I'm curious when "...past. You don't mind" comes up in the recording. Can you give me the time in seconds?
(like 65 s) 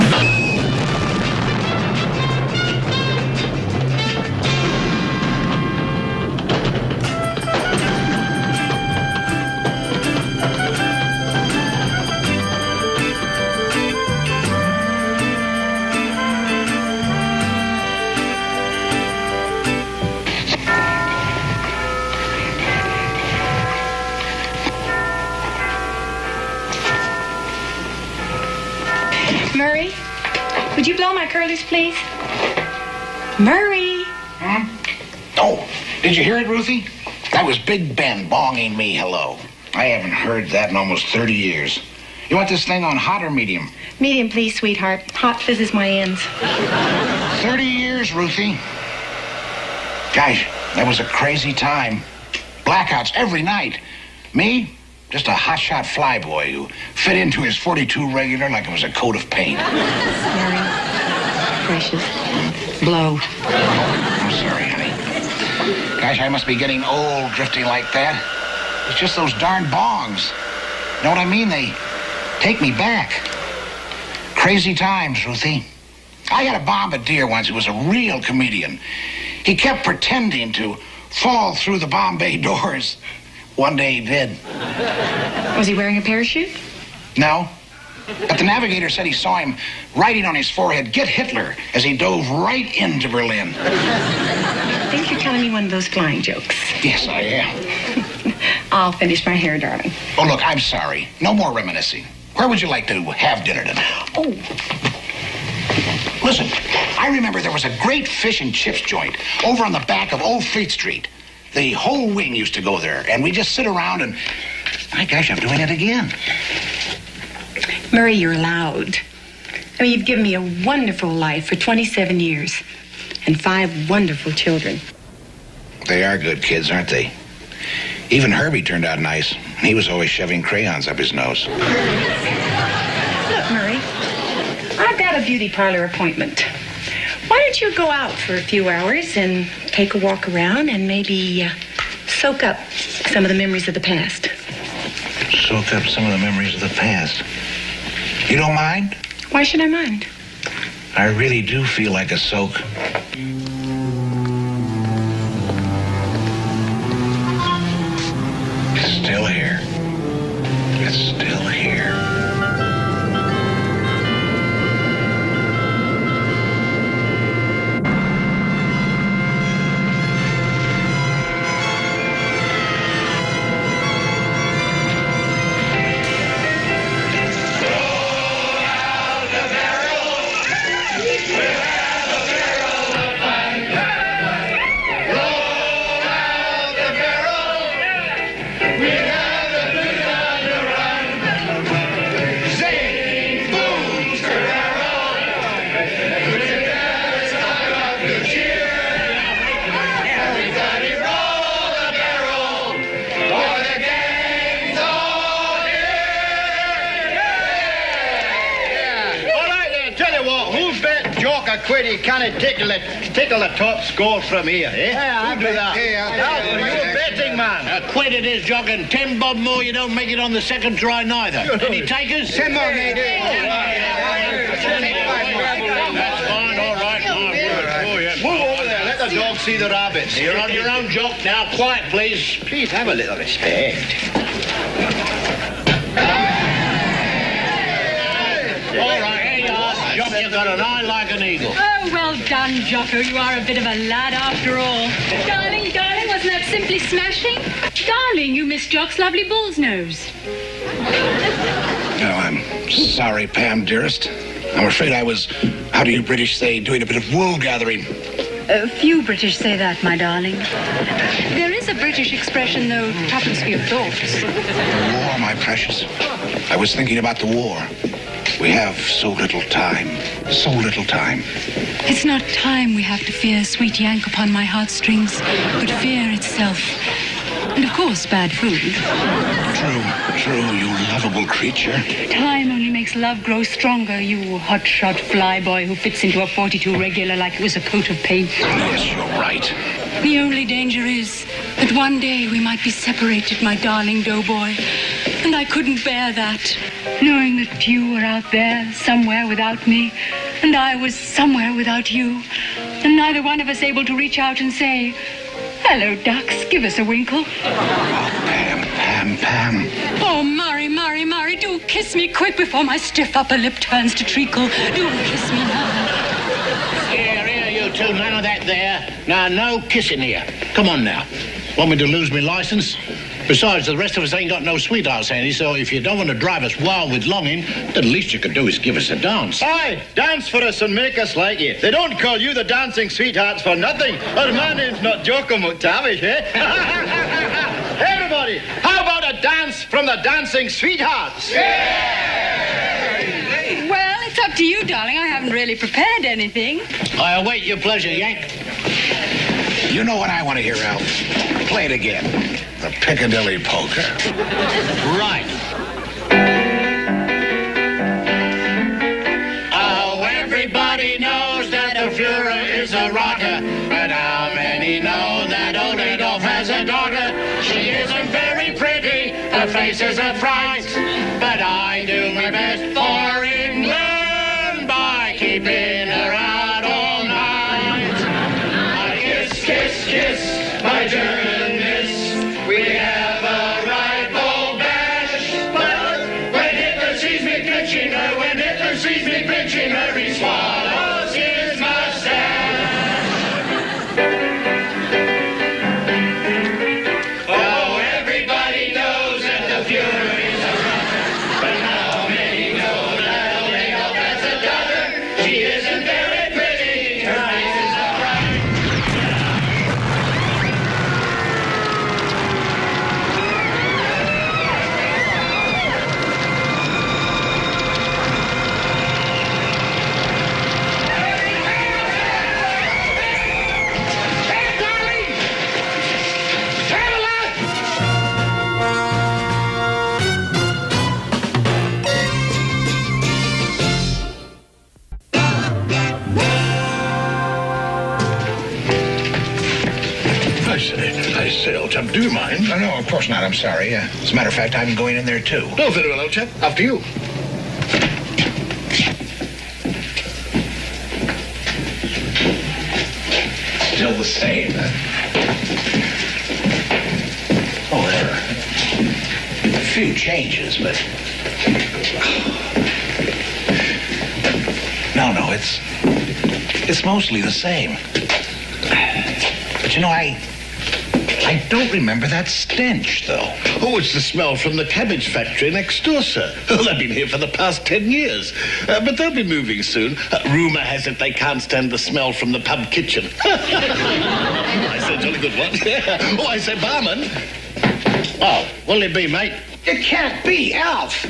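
146 s.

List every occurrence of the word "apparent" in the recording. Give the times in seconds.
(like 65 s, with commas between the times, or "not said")
not said.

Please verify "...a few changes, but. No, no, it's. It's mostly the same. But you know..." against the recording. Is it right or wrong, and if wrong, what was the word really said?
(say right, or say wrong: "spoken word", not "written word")
right.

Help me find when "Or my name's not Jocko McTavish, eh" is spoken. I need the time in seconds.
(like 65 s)
333 s.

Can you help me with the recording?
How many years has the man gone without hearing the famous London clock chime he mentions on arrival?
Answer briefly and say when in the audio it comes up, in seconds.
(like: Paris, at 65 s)
30, at 40 s.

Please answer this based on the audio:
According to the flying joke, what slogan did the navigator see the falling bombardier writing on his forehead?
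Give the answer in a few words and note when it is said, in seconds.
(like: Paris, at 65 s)
Get Hitler, at 90 s.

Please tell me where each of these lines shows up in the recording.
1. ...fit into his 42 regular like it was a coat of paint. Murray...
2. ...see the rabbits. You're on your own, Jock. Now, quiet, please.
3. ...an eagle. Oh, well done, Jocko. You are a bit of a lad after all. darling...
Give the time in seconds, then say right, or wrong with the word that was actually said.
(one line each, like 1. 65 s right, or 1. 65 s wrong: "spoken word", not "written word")
1. 56 s right
2. 229 s right
3. 241 s right.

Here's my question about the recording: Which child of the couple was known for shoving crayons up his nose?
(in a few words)
Herbie.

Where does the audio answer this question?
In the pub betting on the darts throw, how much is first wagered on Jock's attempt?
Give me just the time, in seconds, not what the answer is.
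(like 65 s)
217 s.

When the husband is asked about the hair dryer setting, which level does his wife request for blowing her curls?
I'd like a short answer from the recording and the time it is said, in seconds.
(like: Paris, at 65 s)
Medium, at 44 s.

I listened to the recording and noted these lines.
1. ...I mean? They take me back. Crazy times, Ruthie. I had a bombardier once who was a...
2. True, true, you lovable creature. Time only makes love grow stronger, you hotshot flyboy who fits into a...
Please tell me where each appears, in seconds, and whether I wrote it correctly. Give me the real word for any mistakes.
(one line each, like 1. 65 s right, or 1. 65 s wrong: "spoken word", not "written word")
1. 71 s right
2. 279 s right.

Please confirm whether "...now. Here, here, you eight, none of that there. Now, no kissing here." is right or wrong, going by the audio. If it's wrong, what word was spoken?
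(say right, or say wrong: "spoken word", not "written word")
wrong: "two", not "eight".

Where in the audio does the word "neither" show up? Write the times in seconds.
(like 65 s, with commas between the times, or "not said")
221 s, 302 s.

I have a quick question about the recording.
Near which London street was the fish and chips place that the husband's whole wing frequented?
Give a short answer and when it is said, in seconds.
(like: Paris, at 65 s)
Old Fleet Street, at 110 s.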